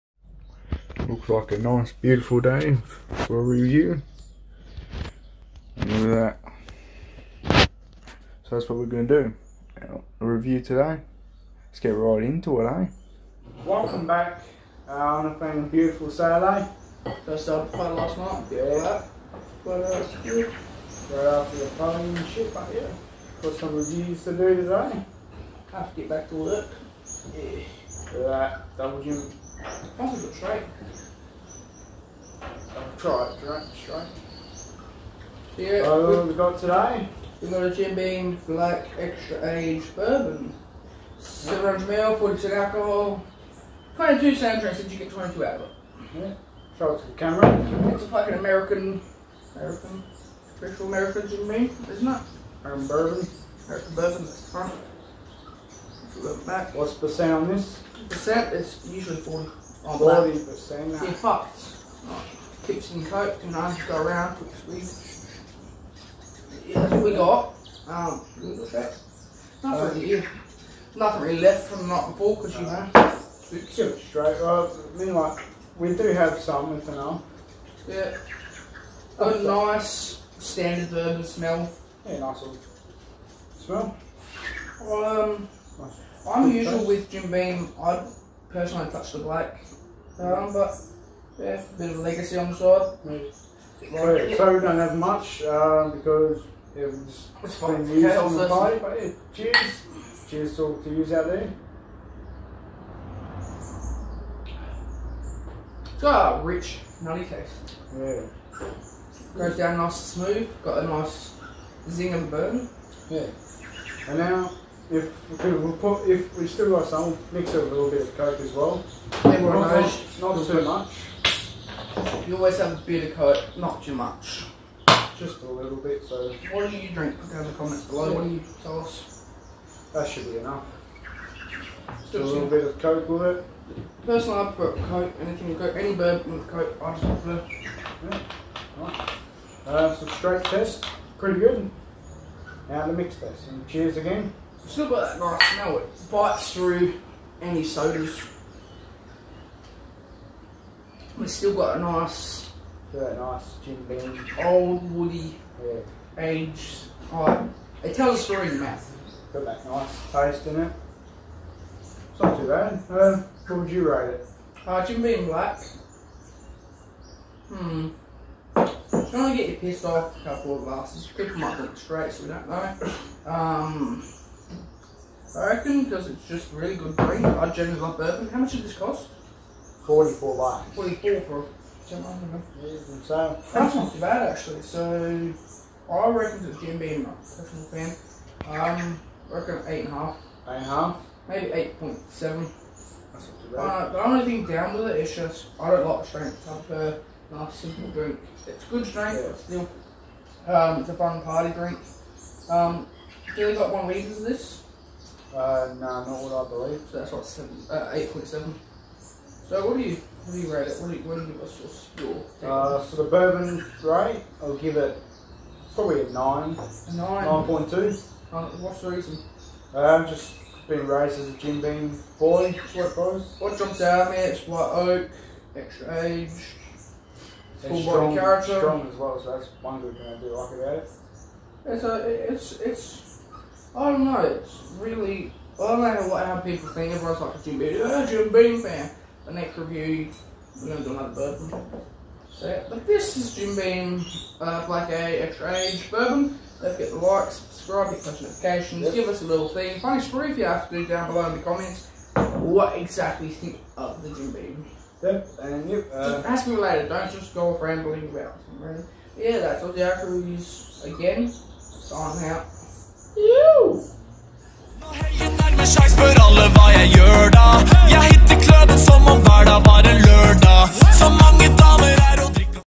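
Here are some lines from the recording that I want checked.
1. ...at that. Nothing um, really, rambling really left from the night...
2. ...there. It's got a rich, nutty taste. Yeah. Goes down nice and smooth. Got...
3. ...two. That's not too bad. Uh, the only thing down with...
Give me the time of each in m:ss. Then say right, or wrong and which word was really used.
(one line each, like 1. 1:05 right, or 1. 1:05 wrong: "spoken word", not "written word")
1. 1:08 wrong: "nothing", not "rambling"
2. 1:41 right
3. 3:12 wrong: "seven", not "two".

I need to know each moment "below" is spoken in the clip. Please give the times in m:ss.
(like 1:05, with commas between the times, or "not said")
2:07, 4:11.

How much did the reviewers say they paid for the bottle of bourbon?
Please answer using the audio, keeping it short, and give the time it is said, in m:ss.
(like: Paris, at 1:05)
$44, at 2:59.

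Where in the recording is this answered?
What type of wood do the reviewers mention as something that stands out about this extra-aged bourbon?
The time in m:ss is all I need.
3:44.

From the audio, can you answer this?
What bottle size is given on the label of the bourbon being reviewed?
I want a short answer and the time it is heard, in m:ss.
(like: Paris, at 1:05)
700ml, at 0:41.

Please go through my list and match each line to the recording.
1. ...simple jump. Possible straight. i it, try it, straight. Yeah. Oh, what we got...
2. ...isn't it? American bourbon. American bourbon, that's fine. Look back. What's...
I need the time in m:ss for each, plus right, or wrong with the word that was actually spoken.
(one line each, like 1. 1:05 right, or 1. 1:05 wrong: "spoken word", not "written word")
1. 0:28 wrong: "double", not "simple"
2. 0:51 right.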